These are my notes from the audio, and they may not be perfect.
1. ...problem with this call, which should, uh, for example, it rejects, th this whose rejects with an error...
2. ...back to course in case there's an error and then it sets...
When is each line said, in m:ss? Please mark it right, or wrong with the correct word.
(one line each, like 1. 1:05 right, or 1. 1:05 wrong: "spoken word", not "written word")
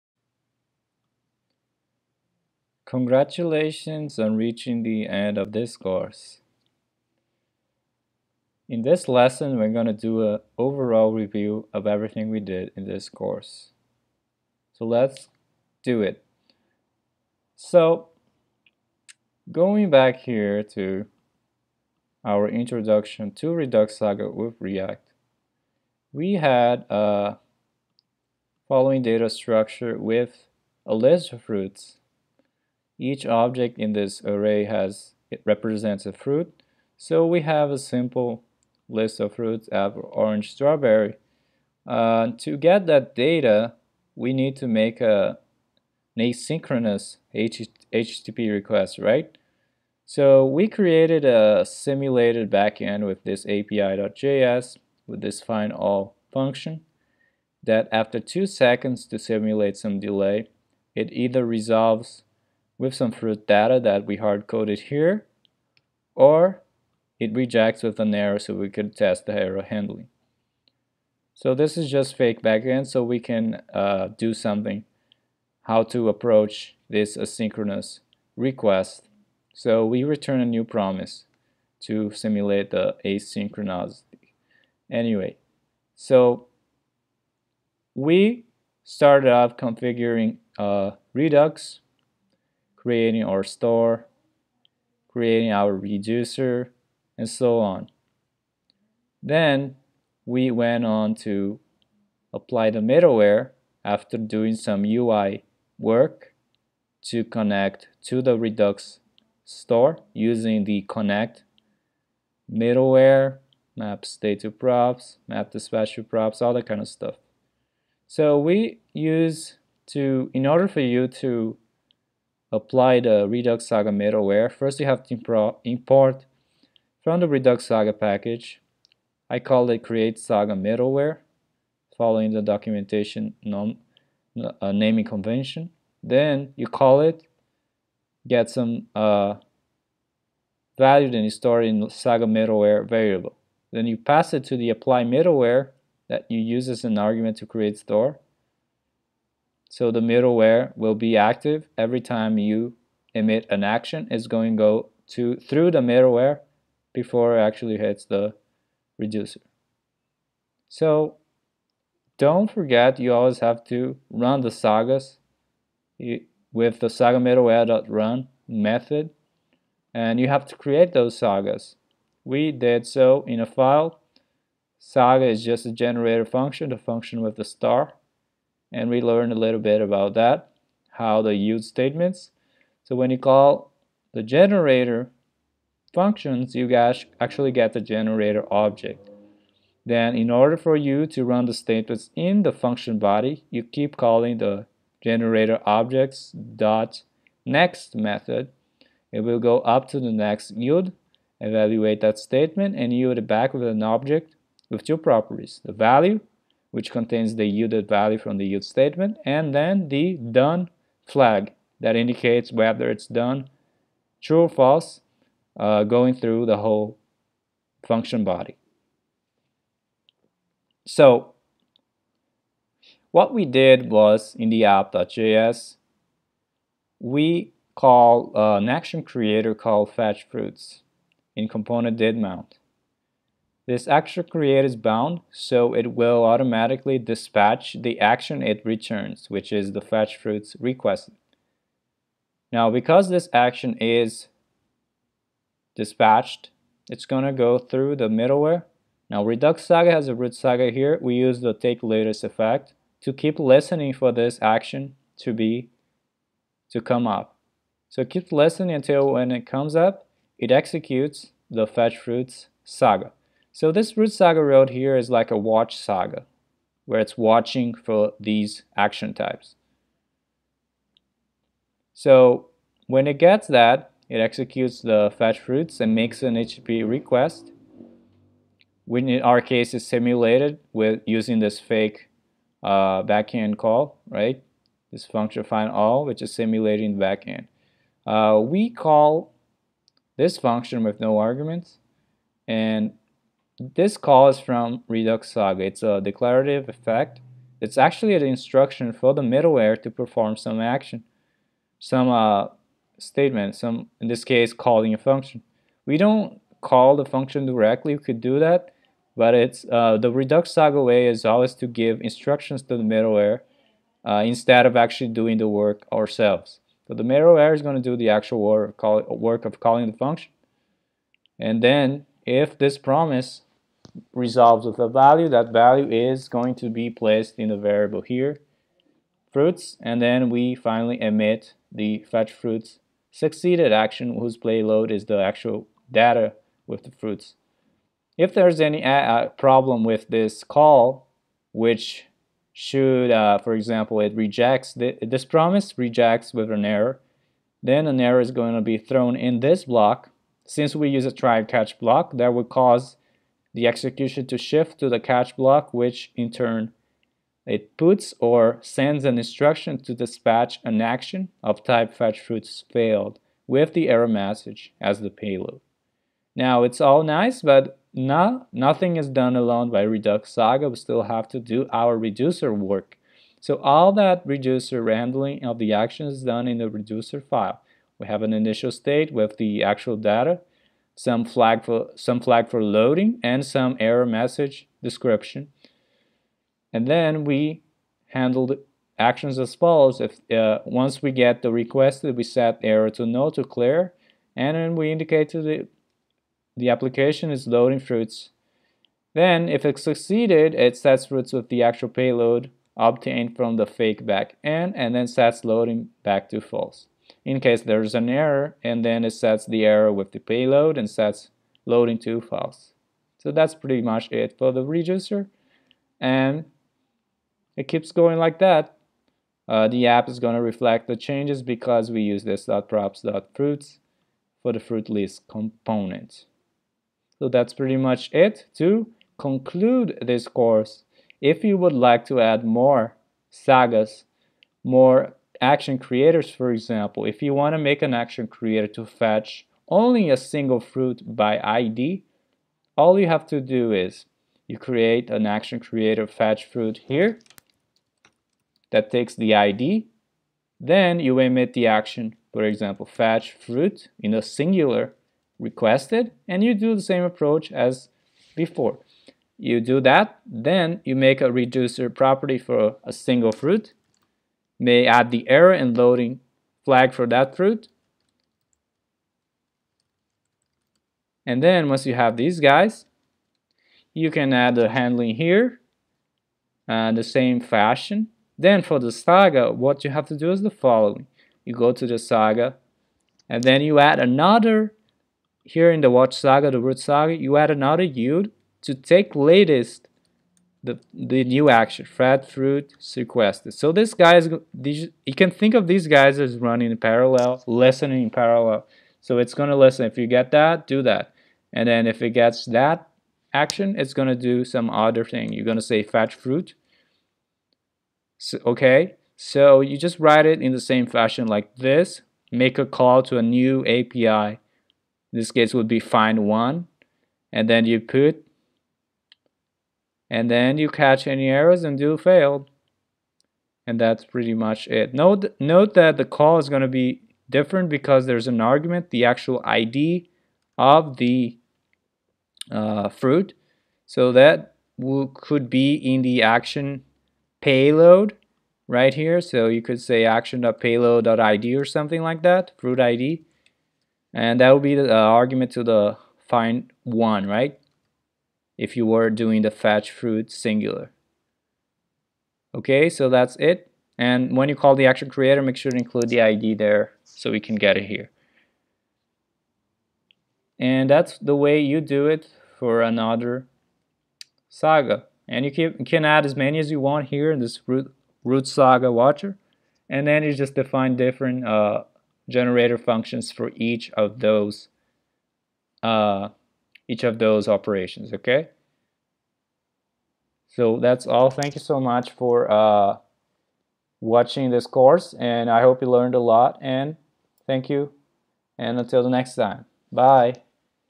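1. 5:39 wrong: "promise", not "whose"
2. 6:46 wrong: "false", not "course".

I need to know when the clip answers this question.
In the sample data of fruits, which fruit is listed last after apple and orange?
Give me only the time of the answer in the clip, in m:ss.
0:40.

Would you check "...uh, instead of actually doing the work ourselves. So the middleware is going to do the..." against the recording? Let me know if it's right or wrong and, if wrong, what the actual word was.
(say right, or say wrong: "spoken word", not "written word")
right.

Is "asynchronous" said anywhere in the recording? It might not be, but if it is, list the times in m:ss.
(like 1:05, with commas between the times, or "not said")
0:46, 1:17, 1:23.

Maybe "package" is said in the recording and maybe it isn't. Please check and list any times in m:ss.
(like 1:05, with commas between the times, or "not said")
2:07.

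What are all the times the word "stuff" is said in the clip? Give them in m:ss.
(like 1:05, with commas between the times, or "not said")
1:56.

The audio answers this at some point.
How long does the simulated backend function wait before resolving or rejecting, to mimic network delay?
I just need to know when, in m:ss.
0:58.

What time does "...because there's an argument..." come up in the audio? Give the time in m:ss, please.
8:47.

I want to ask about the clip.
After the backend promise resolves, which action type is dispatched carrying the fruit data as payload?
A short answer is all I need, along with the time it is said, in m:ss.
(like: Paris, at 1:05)
fetch fruits succeeded, at 5:32.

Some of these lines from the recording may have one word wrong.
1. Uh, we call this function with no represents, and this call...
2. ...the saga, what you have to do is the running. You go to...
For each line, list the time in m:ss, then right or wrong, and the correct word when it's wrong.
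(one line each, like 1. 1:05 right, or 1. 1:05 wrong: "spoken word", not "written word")
1. 4:48 wrong: "arguments", not "represents"
2. 7:58 wrong: "following", not "running".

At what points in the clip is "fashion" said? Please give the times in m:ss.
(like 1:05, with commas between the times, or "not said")
7:57, 8:30.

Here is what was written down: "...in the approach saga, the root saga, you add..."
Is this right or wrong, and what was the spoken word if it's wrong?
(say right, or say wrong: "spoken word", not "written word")
wrong: "watch", not "approach".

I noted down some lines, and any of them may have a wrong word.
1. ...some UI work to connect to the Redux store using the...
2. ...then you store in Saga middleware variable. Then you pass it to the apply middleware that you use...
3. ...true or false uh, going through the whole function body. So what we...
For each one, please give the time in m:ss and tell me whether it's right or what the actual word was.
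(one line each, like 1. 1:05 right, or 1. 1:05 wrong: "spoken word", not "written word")
1. 1:44 right
2. 2:21 right
3. 3:34 right.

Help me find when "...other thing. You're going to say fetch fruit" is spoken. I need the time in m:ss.
8:24.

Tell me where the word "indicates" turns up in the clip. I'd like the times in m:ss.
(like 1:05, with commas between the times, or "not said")
3:31, 6:34.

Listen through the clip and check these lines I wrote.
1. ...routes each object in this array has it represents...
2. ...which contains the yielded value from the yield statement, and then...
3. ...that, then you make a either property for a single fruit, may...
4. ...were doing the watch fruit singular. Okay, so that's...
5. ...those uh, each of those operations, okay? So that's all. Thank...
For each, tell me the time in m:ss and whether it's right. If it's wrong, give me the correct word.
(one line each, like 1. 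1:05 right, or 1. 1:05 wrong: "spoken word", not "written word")
1. 0:31 right
2. 3:26 right
3. 7:39 wrong: "reducer", not "either"
4. 9:08 wrong: "fetch", not "watch"
5. 9:34 right.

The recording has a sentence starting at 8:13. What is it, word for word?
So this guy is, you can think of these guys as running in parallel, listening in parallel.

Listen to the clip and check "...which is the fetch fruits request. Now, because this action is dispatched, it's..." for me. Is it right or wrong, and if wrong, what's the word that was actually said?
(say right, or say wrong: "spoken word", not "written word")
right.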